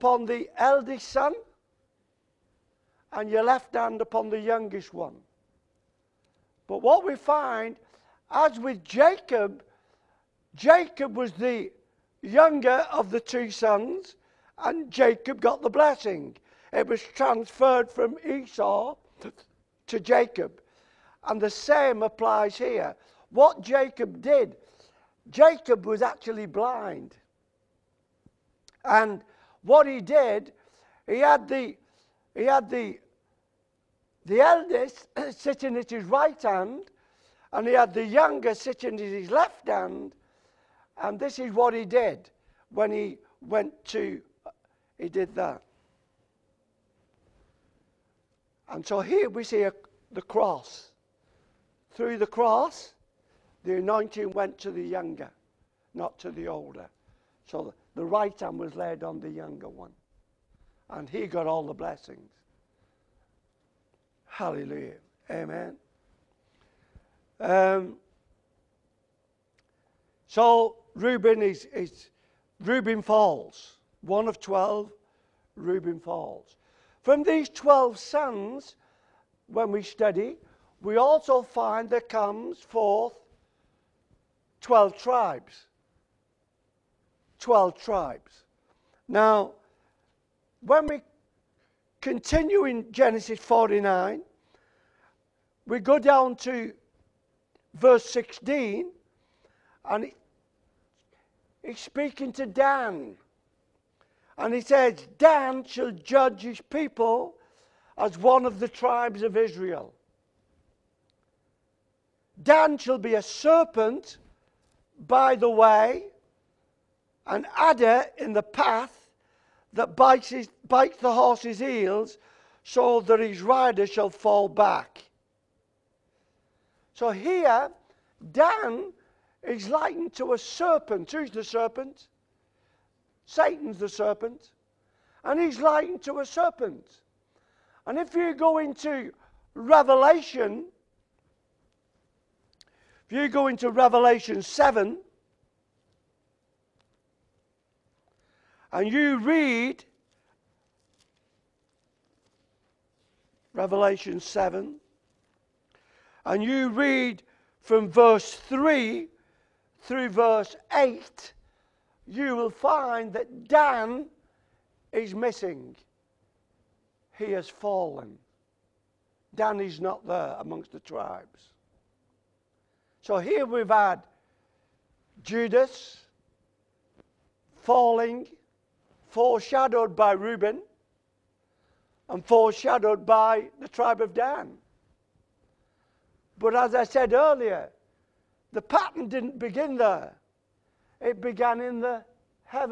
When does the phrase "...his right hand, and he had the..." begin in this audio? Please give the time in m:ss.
0:35.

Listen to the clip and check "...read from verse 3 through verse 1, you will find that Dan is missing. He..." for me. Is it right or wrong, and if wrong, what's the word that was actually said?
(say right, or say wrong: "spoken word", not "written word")
wrong: "8", not "1".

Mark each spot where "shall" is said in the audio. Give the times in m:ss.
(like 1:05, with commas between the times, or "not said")
1:45, 1:52, 2:03.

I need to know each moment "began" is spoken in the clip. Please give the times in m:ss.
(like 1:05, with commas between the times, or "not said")
3:11.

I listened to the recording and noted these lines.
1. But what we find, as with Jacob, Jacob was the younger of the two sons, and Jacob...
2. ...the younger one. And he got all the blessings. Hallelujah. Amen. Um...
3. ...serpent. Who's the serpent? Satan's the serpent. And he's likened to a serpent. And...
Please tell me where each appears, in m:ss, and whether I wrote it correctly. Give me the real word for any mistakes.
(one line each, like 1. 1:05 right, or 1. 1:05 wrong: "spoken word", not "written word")
1. 0:06 right
2. 0:59 right
3. 2:10 right.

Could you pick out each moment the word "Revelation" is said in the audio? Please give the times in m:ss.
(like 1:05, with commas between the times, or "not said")
2:19, 2:23, 2:33.